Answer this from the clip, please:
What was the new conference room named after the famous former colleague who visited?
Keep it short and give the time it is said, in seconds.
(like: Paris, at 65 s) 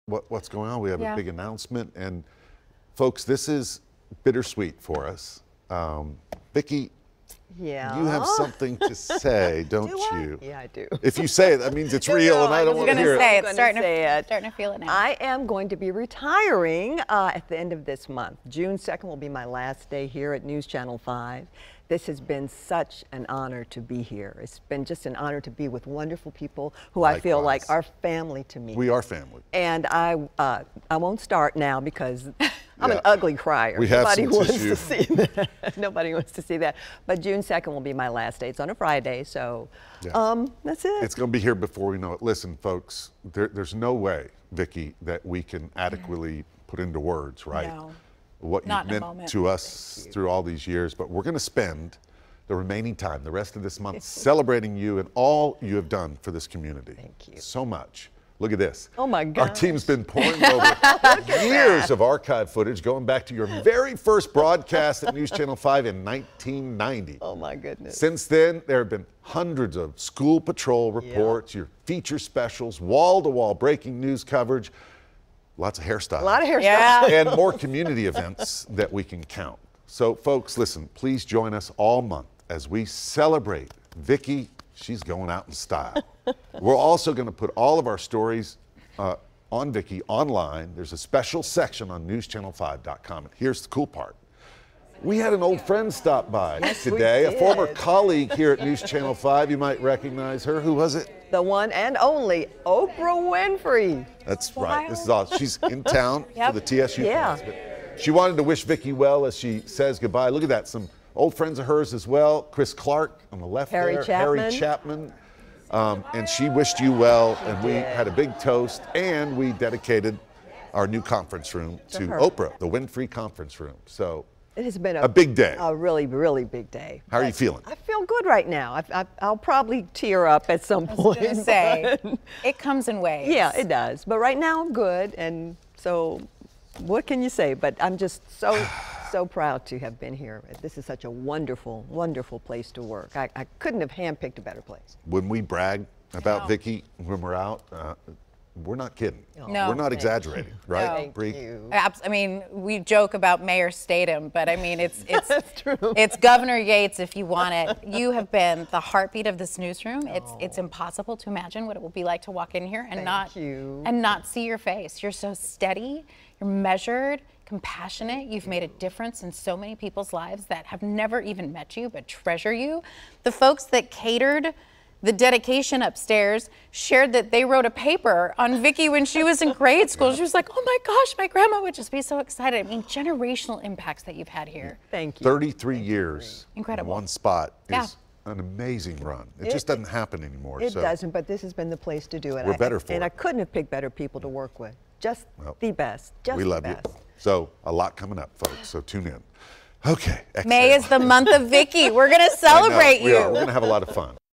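The Winfrey conference room, at 122 s.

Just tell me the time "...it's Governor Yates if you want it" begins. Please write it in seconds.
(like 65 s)
155 s.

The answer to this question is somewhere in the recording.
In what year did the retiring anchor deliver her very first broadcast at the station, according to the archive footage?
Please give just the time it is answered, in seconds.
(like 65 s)
66 s.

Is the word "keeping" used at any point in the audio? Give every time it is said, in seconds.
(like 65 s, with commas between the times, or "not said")
not said.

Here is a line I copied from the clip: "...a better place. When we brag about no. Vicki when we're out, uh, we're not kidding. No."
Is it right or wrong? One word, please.
right.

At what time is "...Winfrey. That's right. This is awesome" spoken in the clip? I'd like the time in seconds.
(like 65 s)
103 s.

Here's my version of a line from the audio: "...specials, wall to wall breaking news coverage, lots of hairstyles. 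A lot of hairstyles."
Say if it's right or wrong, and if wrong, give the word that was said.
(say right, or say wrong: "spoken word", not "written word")
right.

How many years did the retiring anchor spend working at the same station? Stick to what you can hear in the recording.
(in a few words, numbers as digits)
33.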